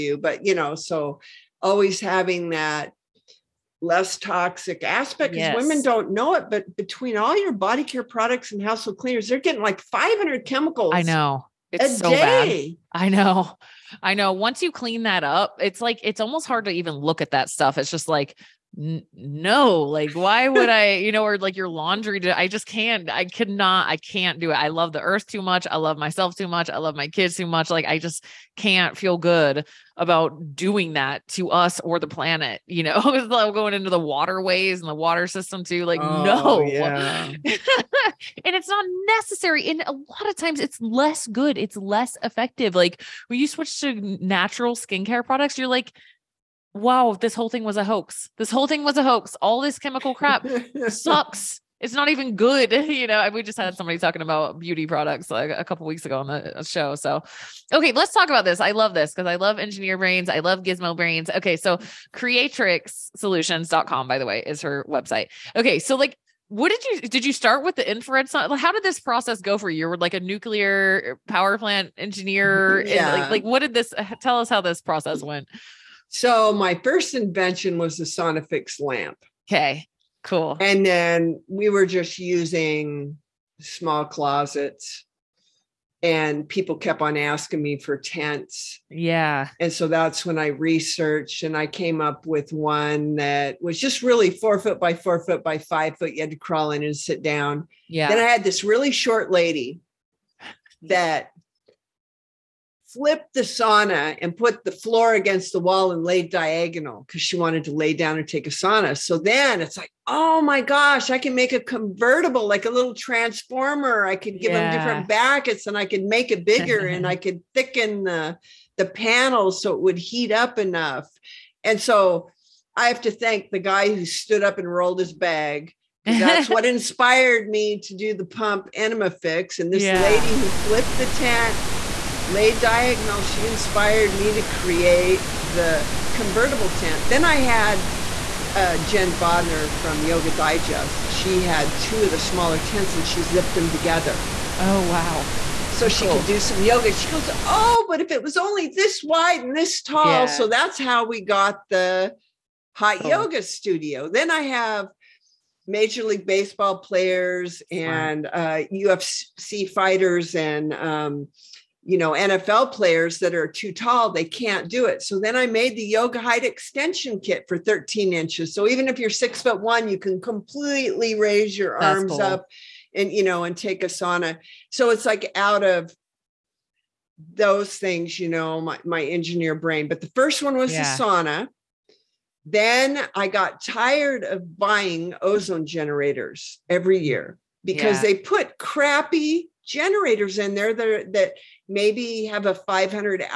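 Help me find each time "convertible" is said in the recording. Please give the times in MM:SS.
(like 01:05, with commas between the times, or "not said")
01:51, 02:16.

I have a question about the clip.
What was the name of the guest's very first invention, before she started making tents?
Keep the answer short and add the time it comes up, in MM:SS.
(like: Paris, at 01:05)
Sonifix lamp, at 01:18.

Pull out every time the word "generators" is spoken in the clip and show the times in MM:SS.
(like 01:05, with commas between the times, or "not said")
03:05, 03:09.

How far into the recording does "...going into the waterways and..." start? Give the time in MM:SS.
00:33.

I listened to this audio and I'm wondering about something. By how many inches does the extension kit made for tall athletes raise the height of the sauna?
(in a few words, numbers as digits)
13.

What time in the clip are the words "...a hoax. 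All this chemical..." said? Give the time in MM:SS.
00:48.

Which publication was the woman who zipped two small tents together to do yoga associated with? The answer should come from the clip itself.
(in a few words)
Yoga Digest.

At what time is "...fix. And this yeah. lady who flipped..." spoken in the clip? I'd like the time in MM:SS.
02:09.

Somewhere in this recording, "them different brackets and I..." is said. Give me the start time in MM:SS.
01:54.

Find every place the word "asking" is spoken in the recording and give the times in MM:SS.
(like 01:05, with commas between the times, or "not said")
01:27.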